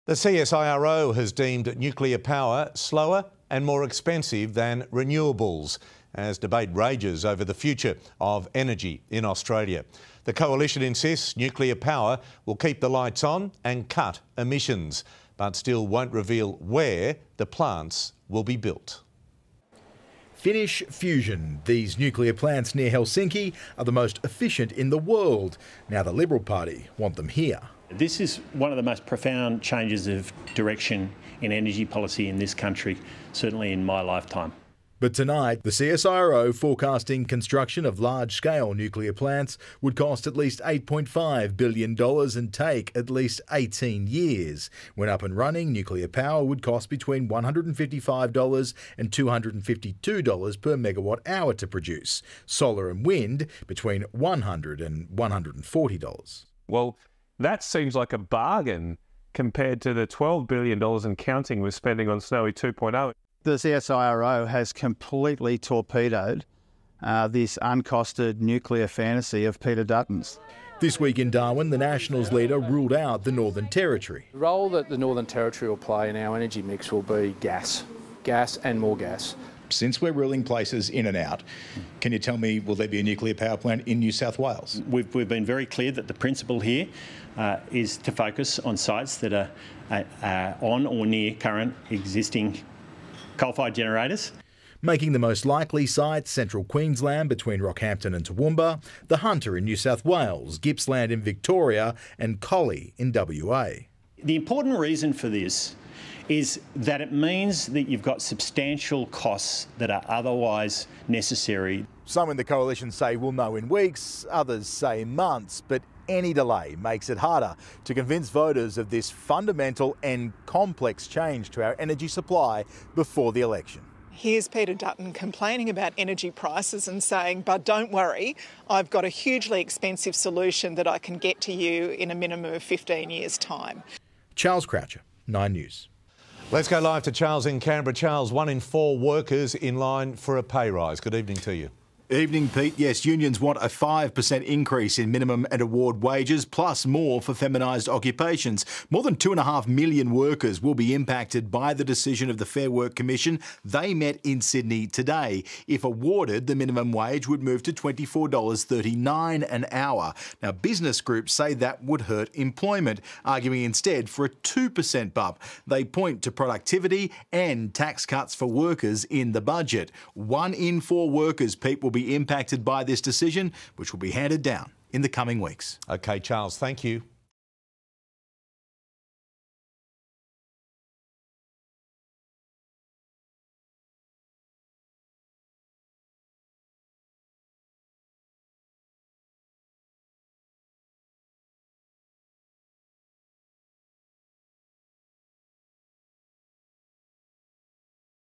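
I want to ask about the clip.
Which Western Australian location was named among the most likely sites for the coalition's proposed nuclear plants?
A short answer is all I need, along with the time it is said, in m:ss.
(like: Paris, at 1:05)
Collie, at 1:42.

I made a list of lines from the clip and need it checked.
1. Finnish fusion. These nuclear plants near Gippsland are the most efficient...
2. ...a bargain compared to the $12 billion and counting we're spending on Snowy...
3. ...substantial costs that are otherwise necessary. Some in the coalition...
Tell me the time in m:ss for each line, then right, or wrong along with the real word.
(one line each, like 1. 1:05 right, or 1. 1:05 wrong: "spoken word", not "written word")
1. 0:20 wrong: "Helsinki", not "Gippsland"
2. 0:58 right
3. 1:48 right.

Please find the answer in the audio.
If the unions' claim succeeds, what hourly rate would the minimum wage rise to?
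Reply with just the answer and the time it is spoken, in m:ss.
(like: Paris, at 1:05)
$24.39, at 2:37.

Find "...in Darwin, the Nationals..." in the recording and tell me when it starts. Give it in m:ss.
1:11.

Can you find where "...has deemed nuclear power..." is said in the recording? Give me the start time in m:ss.
0:01.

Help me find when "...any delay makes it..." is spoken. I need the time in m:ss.
1:56.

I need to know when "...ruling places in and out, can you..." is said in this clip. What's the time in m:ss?
1:20.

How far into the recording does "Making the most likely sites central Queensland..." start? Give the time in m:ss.
1:34.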